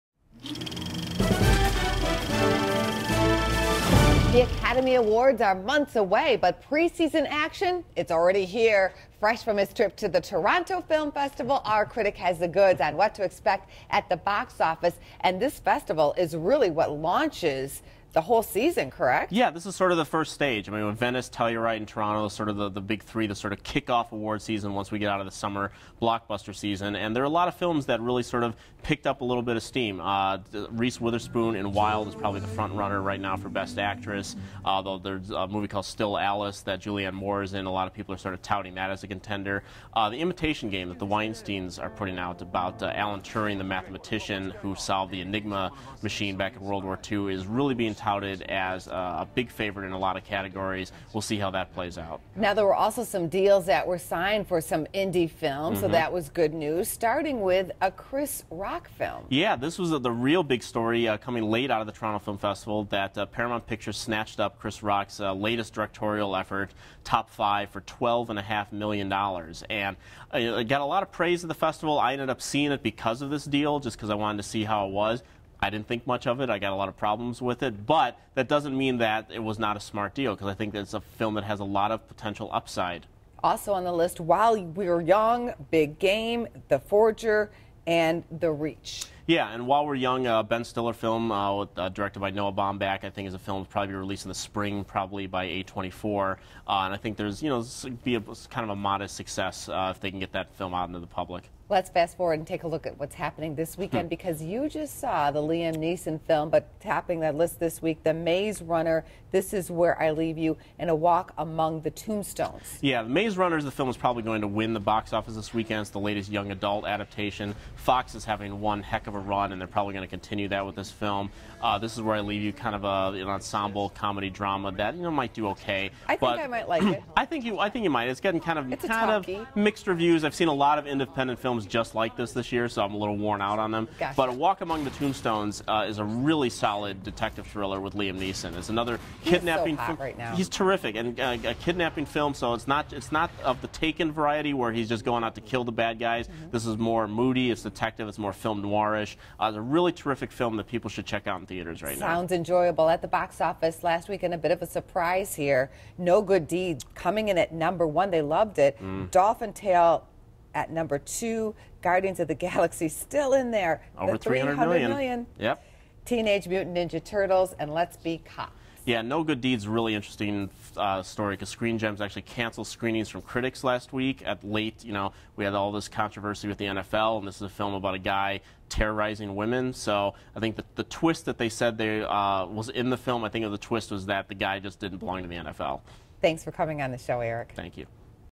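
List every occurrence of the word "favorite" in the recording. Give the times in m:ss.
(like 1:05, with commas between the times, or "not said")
0:49.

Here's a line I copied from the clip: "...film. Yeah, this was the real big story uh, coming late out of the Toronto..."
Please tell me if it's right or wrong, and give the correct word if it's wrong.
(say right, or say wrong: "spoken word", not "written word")
right.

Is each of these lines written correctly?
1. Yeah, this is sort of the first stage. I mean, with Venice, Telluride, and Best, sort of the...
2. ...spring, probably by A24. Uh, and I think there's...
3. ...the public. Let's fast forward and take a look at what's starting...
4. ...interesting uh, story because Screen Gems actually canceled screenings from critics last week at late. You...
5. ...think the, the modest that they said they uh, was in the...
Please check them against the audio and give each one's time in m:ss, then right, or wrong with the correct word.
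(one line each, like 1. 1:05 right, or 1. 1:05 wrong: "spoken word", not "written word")
1. 0:19 wrong: "Toronto", not "Best"
2. 1:34 right
3. 1:40 wrong: "happening", not "starting"
4. 2:49 right
5. 3:00 wrong: "twist", not "modest".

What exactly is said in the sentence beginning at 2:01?
Uh, this is where I leave you kind of a, an ensemble comedy drama that you know might do okay.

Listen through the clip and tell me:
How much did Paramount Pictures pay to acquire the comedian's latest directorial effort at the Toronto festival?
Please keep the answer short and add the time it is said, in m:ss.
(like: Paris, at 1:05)
$12.5 million, at 1:07.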